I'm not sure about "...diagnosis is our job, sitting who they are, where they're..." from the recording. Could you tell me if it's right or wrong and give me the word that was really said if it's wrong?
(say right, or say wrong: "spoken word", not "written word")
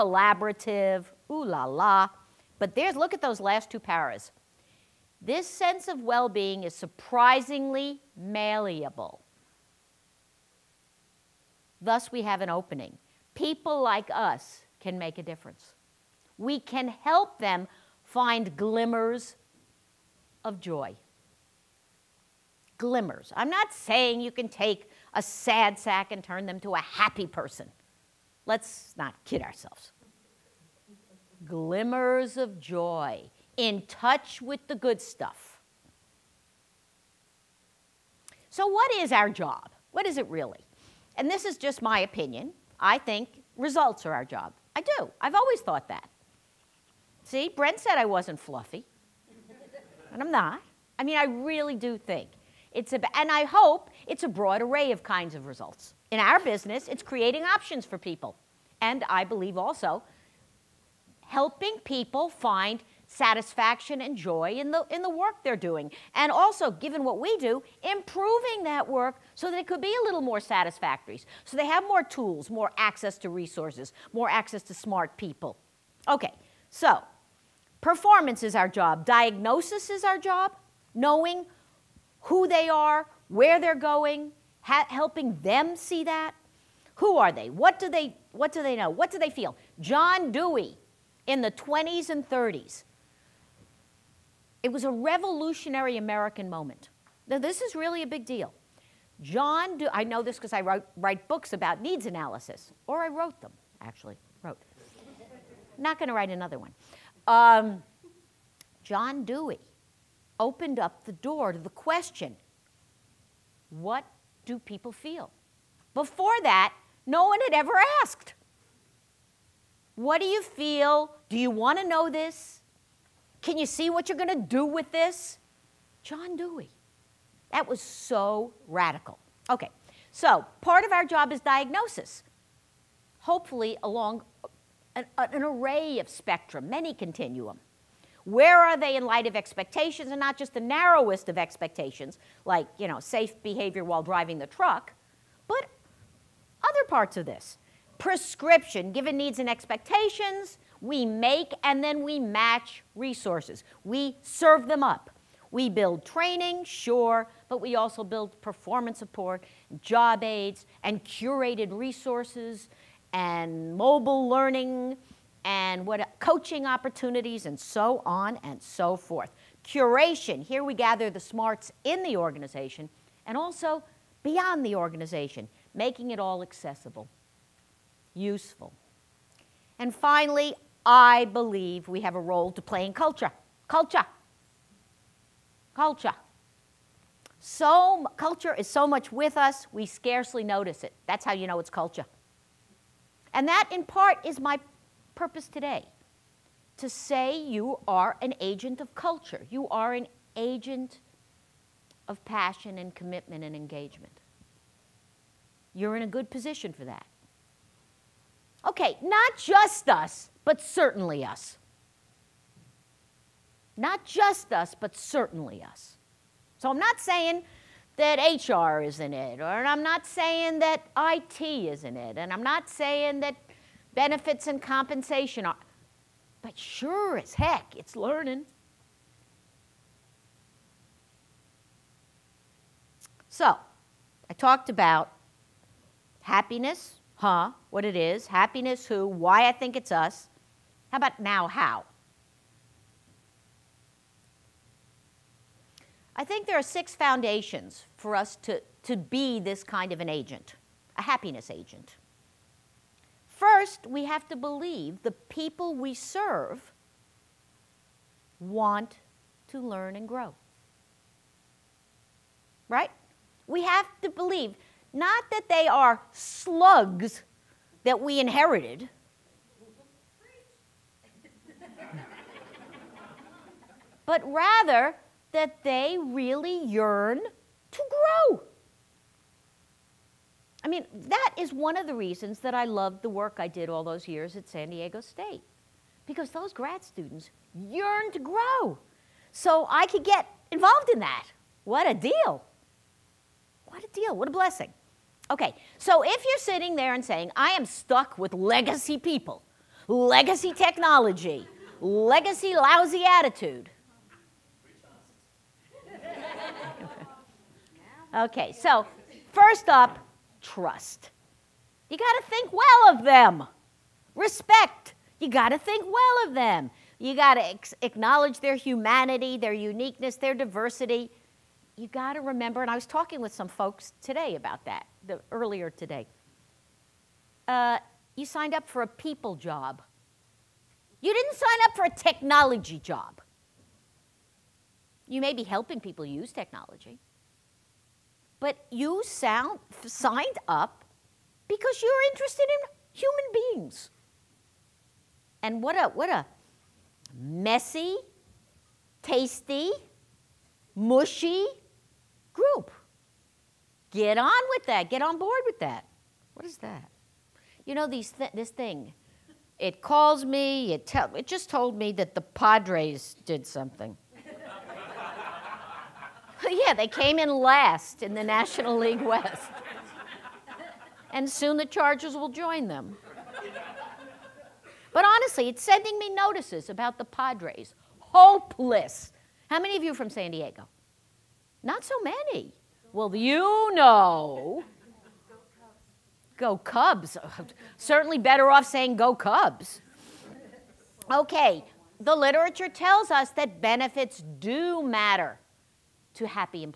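wrong: "knowing", not "sitting".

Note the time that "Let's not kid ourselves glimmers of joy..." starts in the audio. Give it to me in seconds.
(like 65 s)
28 s.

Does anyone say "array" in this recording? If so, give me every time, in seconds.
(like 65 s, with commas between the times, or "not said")
54 s, 135 s.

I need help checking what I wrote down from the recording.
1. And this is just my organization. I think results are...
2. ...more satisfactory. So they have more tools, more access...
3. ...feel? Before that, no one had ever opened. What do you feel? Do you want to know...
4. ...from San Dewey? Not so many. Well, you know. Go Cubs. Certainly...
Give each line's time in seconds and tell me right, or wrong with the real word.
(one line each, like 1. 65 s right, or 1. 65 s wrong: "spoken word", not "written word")
1. 41 s wrong: "opinion", not "organization"
2. 70 s right
3. 114 s wrong: "asked", not "opened"
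4. 380 s wrong: "Diego", not "Dewey".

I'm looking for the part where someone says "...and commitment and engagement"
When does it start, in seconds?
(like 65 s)
202 s.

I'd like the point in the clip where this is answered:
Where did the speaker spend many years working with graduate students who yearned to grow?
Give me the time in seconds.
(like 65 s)
284 s.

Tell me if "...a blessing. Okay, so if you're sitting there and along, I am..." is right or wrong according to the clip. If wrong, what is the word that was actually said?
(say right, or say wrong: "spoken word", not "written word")
wrong: "saying", not "along".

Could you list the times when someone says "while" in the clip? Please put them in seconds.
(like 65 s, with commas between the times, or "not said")
143 s.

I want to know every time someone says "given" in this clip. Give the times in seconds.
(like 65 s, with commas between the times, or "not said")
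66 s, 148 s.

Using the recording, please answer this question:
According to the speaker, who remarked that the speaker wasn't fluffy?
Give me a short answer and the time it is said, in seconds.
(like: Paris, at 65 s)
Brent, at 47 s.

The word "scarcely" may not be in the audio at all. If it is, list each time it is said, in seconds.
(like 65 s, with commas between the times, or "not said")
189 s.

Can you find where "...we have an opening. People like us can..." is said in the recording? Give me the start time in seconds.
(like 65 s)
12 s.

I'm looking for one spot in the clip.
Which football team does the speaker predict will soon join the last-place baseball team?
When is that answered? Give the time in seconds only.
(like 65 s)
371 s.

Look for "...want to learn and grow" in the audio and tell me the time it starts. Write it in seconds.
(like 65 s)
258 s.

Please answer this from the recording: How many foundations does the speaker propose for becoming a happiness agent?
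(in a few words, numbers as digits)
6.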